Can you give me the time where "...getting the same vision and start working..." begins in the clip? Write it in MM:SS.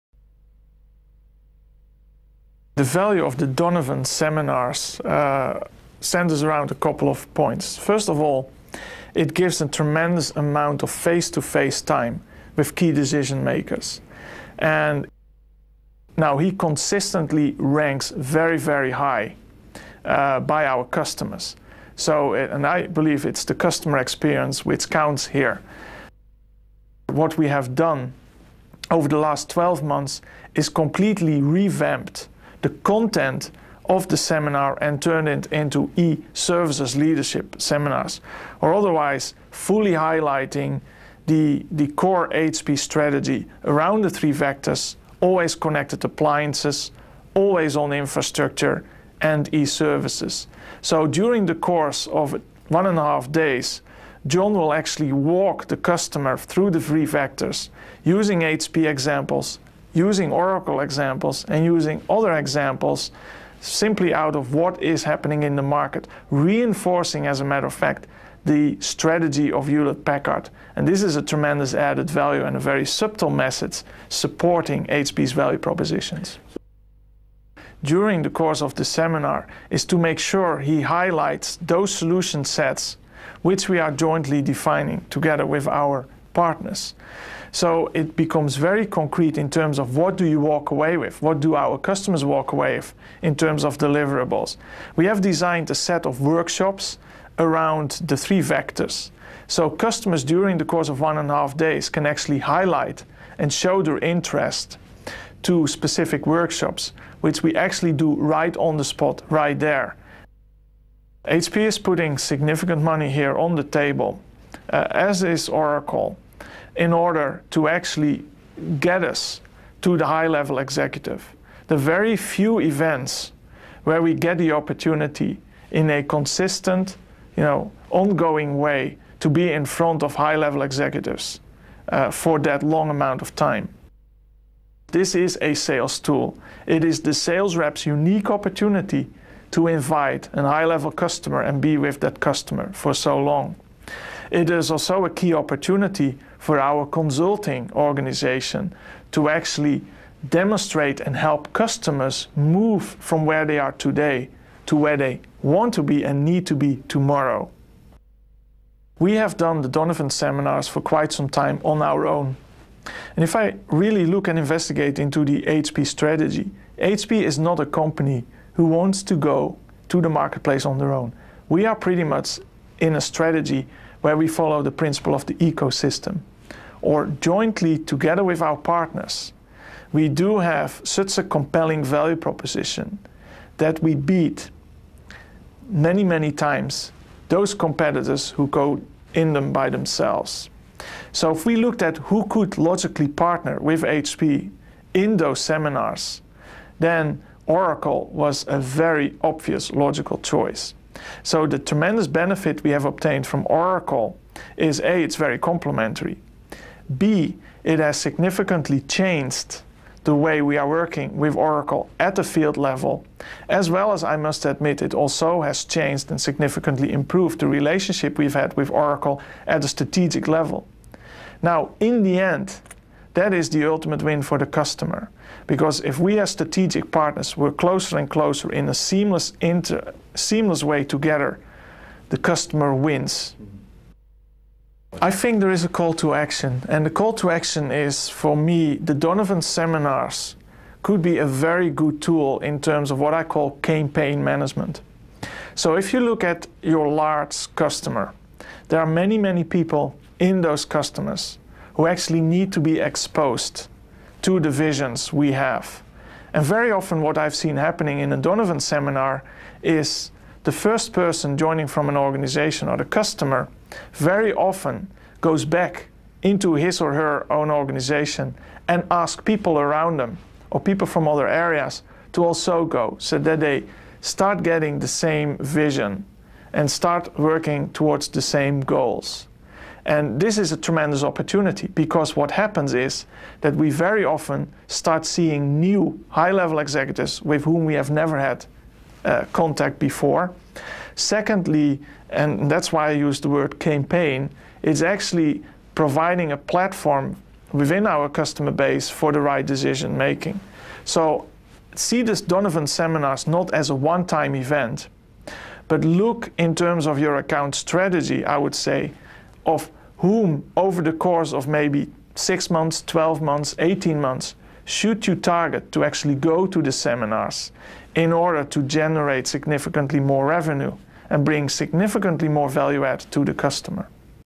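04:34.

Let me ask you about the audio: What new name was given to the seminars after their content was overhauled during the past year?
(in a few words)
e-services leadership seminars.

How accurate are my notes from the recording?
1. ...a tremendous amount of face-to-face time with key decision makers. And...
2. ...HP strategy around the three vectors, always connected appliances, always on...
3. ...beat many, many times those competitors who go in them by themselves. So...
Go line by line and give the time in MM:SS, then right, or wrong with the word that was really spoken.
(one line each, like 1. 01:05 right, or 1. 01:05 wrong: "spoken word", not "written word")
1. 00:09 right
2. 00:42 right
3. 03:03 right.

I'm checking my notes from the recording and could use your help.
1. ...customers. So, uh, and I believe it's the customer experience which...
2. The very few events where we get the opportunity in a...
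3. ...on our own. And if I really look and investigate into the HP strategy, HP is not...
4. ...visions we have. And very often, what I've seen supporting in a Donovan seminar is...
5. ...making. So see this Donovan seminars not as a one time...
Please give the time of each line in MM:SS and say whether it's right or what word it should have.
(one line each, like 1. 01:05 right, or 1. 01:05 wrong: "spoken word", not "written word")
1. 00:20 right
2. 02:01 right
3. 02:41 right
4. 04:14 wrong: "happening", not "supporting"
5. 04:59 right.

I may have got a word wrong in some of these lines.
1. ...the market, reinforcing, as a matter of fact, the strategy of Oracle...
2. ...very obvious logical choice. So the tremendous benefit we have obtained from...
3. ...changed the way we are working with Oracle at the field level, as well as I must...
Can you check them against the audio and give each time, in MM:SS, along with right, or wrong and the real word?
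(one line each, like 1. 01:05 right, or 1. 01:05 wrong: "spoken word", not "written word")
1. 01:05 wrong: "Hewlett", not "Oracle"
2. 03:18 right
3. 03:28 right.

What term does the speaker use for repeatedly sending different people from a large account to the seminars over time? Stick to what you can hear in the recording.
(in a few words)
campaign management.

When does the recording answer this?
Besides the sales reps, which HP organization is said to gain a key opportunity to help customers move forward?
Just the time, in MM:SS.
02:26.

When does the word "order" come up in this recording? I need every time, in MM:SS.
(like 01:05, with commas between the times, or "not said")
01:56, 05:18.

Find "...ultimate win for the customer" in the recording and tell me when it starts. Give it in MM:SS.
03:43.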